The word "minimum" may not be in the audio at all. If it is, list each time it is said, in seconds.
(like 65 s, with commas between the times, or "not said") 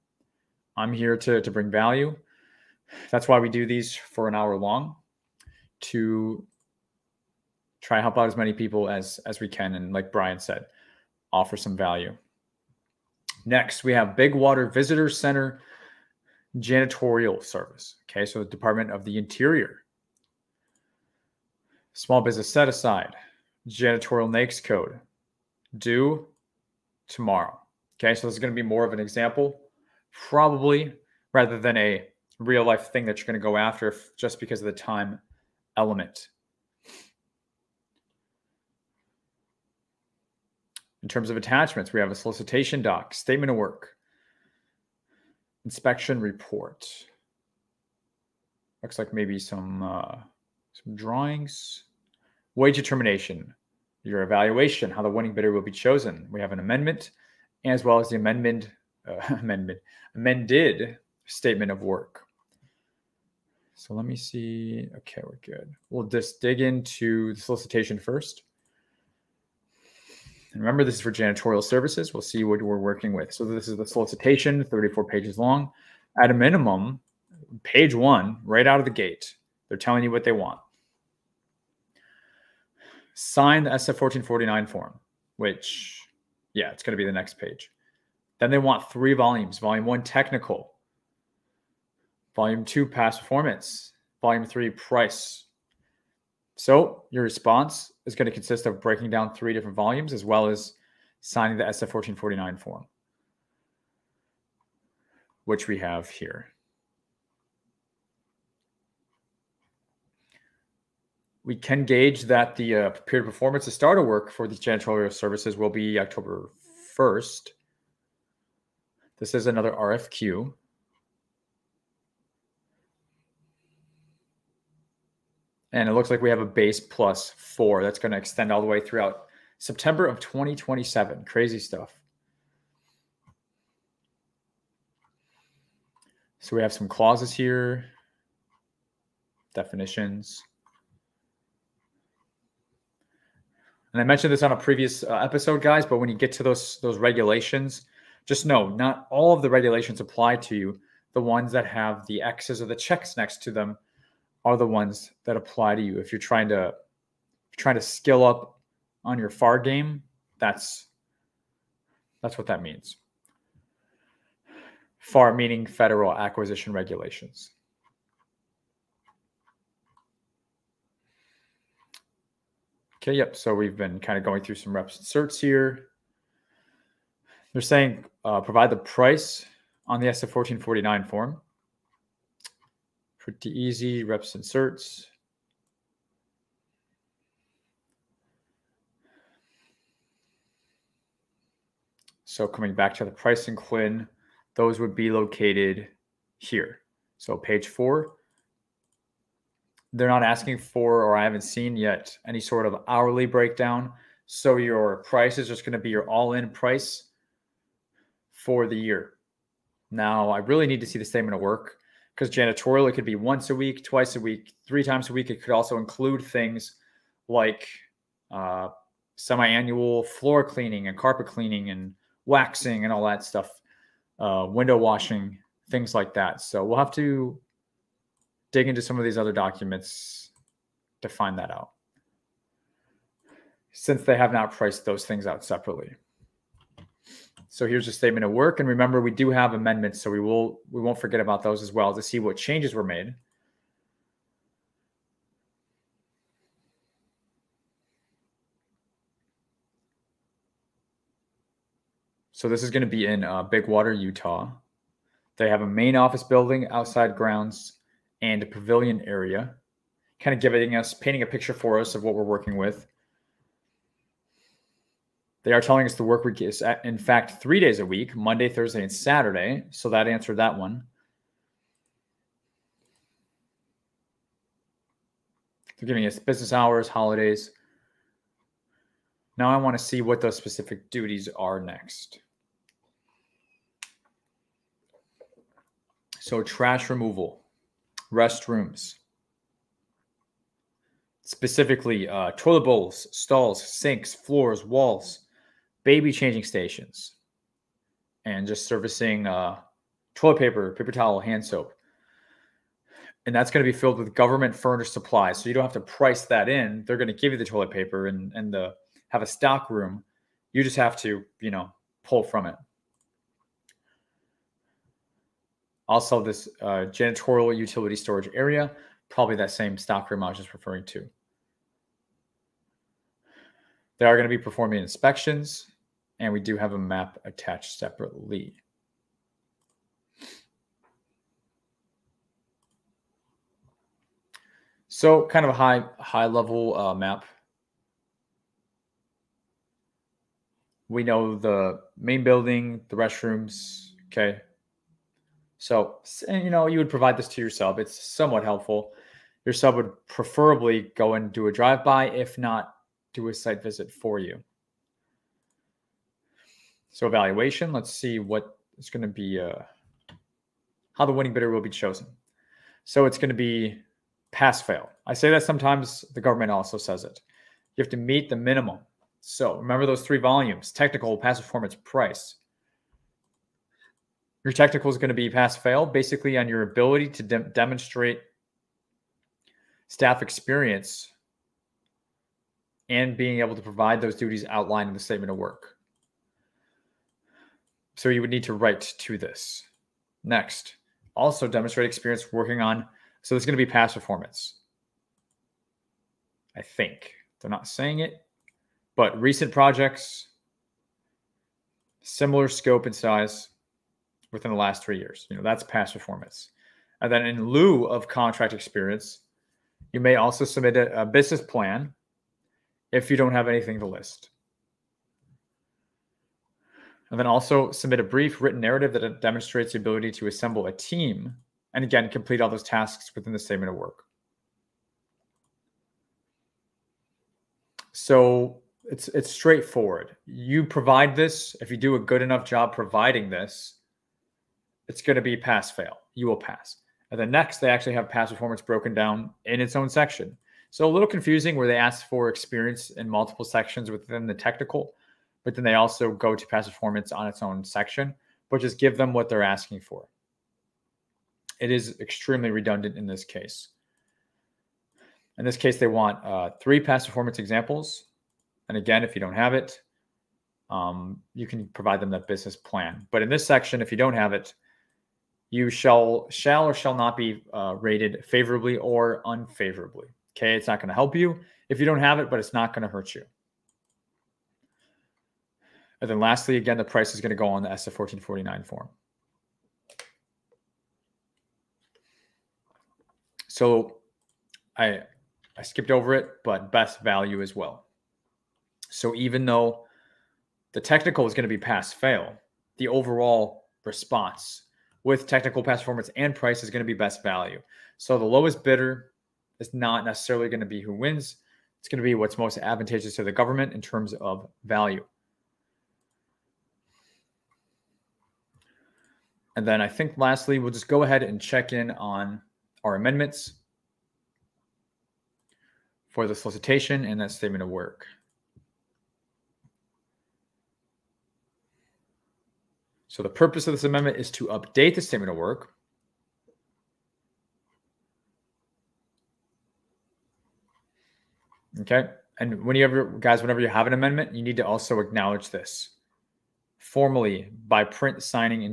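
76 s, 368 s.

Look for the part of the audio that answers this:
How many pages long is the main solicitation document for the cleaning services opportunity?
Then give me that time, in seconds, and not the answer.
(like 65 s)
74 s.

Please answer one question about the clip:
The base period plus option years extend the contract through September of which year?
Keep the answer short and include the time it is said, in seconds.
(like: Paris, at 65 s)
2027, at 130 s.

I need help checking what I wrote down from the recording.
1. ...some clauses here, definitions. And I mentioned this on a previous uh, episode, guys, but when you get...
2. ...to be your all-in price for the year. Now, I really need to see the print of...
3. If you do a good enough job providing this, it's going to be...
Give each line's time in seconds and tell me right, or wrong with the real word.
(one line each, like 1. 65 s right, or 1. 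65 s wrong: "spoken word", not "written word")
1. 136 s right
2. 205 s wrong: "statement", not "print"
3. 431 s right.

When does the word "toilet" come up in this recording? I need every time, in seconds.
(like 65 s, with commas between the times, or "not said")
292 s, 300 s, 307 s.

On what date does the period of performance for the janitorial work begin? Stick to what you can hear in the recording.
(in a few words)
October 1st.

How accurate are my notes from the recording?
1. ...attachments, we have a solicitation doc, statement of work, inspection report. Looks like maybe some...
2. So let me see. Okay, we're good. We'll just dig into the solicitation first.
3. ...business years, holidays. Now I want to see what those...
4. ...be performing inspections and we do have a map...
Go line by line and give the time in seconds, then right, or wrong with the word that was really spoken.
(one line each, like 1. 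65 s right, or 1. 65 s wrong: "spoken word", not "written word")
1. 41 s right
2. 63 s right
3. 276 s wrong: "hours", not "years"
4. 324 s right.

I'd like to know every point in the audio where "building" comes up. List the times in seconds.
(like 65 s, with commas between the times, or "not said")
256 s, 342 s.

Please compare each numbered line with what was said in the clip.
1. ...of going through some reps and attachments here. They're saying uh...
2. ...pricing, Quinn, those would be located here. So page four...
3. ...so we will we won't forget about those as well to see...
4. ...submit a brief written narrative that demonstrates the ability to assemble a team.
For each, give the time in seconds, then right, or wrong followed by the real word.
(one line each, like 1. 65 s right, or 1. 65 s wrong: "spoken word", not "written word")
1. 174 s wrong: "certs", not "attachments"
2. 193 s right
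3. 240 s right
4. 417 s right.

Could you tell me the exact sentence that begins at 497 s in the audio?
So the lowest bidder is not necessarily going to be who wins.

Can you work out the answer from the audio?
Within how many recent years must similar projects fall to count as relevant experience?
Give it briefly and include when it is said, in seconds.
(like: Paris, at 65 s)
3, at 404 s.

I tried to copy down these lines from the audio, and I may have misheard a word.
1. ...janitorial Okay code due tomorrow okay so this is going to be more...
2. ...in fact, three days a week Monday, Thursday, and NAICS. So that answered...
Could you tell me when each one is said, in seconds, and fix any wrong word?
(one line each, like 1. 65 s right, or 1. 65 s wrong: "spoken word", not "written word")
1. 23 s wrong: "NAICS", not "Okay"
2. 266 s wrong: "Saturday", not "NAICS".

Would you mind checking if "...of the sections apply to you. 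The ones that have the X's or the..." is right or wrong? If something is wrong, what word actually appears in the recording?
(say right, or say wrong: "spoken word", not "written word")
wrong: "regulations", not "sections".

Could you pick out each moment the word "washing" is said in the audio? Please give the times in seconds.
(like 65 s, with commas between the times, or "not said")
224 s.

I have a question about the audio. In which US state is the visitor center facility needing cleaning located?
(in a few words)
Utah.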